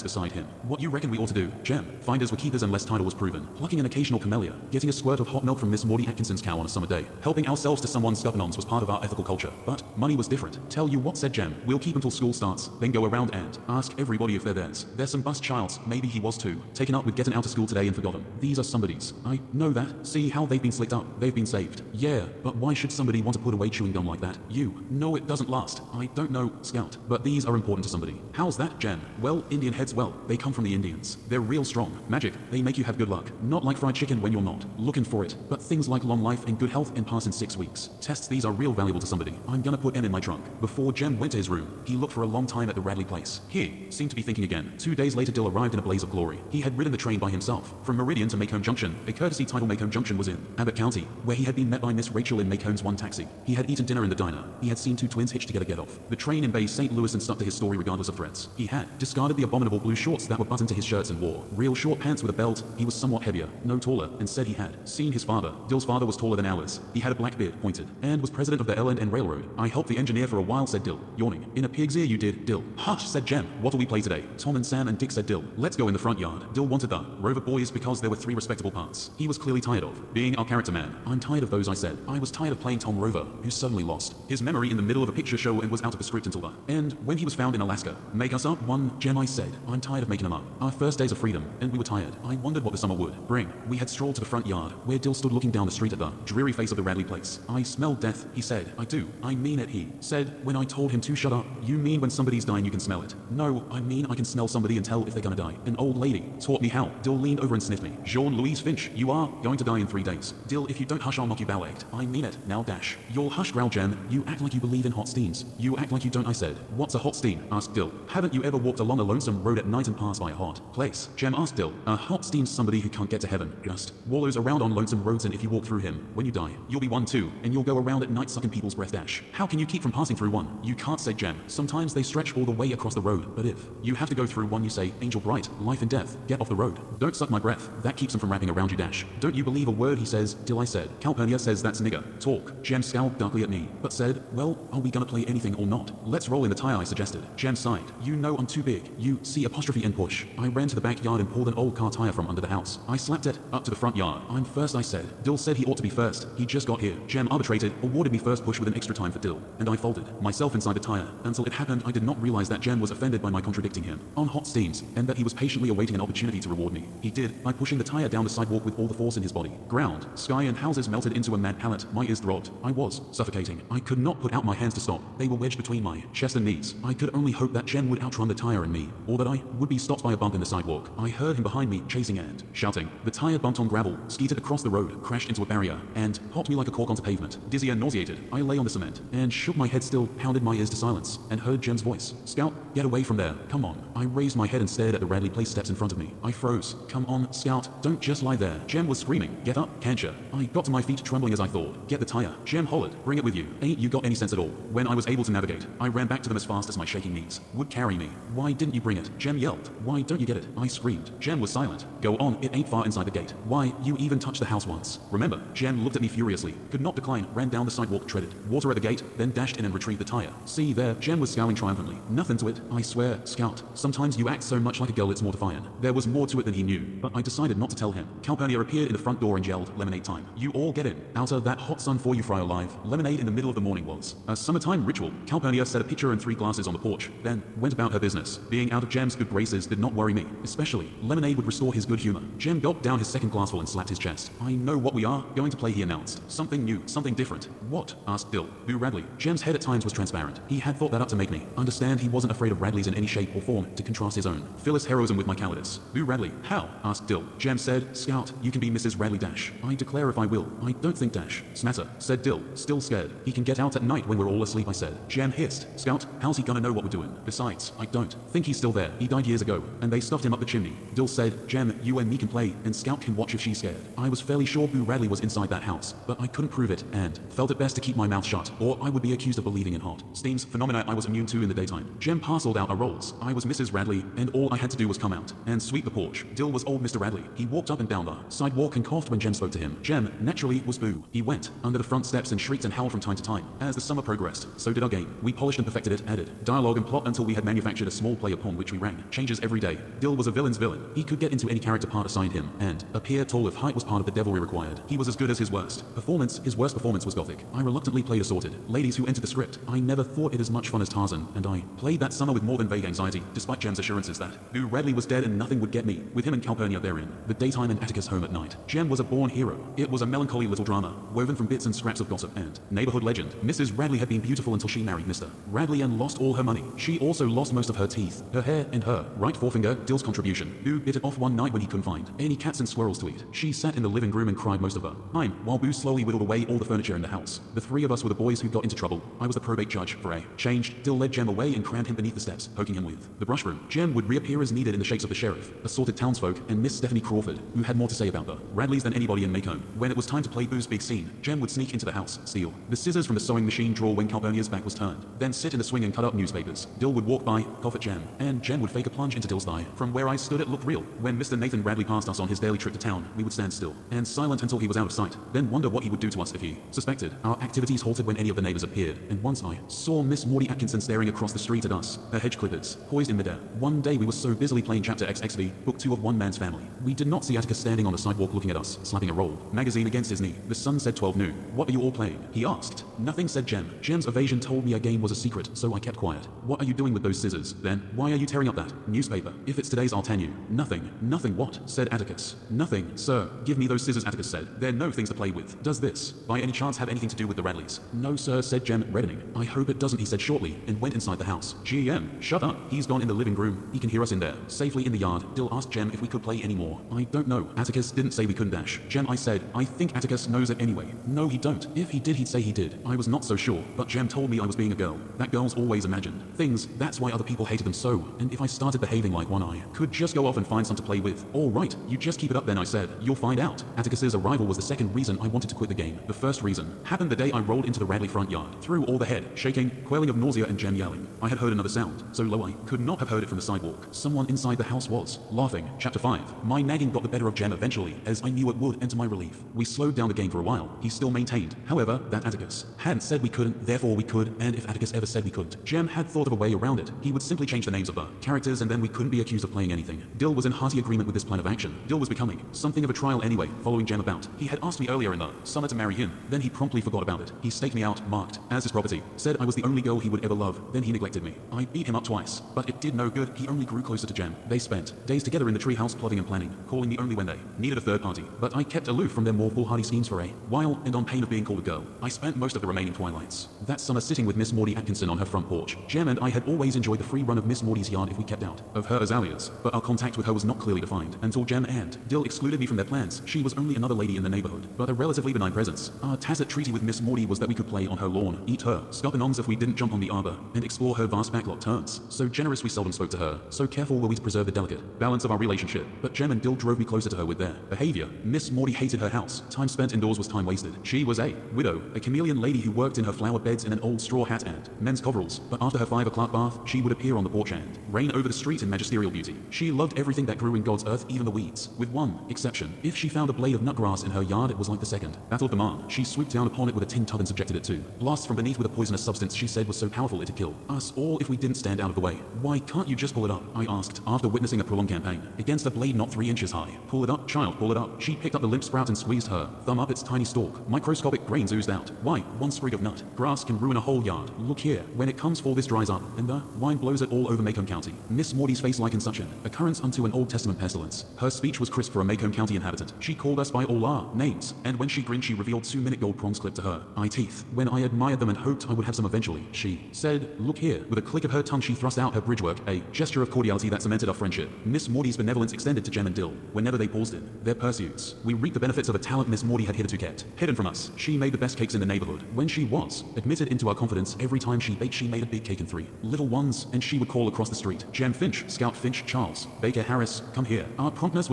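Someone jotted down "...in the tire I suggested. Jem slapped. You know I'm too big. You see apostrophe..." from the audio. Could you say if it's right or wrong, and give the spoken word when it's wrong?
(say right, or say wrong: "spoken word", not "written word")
wrong: "sighed", not "slapped".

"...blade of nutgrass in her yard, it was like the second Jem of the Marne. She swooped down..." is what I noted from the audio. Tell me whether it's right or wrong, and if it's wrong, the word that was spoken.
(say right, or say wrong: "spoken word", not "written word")
wrong: "Battle", not "Jem".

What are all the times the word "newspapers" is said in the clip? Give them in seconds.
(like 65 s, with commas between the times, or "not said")
356 s, 388 s.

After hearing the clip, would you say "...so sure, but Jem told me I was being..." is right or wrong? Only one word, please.
right.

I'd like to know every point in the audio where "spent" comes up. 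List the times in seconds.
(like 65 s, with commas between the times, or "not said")
464 s, 472 s, 499 s.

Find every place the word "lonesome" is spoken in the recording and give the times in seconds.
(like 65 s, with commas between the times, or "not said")
119 s, 124 s.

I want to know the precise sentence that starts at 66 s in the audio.
He had a black beard, pointed, and was president of the L&N Railroad.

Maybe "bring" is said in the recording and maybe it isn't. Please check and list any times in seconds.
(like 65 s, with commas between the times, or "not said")
93 s, 203 s, 208 s.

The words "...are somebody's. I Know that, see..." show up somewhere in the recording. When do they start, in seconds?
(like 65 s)
18 s.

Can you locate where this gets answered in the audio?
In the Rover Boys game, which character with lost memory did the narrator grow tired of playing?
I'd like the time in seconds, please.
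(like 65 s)
82 s.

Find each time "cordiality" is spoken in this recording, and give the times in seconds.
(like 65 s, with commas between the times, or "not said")
553 s.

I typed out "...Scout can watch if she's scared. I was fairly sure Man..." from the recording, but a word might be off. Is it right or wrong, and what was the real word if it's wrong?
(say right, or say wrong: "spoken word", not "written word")
wrong: "Boo", not "Man".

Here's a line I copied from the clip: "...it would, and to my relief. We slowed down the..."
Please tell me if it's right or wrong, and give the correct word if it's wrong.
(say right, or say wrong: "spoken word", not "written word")
right.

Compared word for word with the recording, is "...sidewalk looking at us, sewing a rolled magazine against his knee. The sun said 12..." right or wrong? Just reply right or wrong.
wrong.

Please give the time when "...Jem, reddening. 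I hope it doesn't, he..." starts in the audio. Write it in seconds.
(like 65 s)
398 s.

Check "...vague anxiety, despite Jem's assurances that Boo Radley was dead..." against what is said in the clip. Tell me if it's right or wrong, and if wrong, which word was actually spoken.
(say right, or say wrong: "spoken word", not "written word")
right.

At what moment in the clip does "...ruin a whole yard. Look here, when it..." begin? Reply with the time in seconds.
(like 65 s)
533 s.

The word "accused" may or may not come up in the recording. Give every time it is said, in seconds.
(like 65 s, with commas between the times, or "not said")
279 s, 449 s.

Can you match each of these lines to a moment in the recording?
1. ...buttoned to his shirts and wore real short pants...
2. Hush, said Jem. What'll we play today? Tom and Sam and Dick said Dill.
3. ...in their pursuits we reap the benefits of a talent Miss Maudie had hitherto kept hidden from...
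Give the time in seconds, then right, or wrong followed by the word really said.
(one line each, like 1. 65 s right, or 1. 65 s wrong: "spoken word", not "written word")
1. 60 s right
2. 72 s right
3. 557 s right.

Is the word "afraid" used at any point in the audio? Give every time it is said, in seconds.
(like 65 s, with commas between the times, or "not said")
252 s.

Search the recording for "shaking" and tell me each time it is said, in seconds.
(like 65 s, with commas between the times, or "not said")
206 s, 429 s.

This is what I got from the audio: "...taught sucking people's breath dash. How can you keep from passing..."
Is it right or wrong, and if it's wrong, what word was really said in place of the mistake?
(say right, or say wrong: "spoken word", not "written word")
wrong: "night", not "taught".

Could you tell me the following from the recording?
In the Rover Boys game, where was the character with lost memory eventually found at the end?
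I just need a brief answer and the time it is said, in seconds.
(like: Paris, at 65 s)
Alaska, at 87 s.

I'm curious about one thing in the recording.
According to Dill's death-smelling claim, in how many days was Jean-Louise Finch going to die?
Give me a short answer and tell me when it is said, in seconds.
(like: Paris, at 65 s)
3, at 109 s.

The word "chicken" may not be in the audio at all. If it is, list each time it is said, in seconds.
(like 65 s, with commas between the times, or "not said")
33 s.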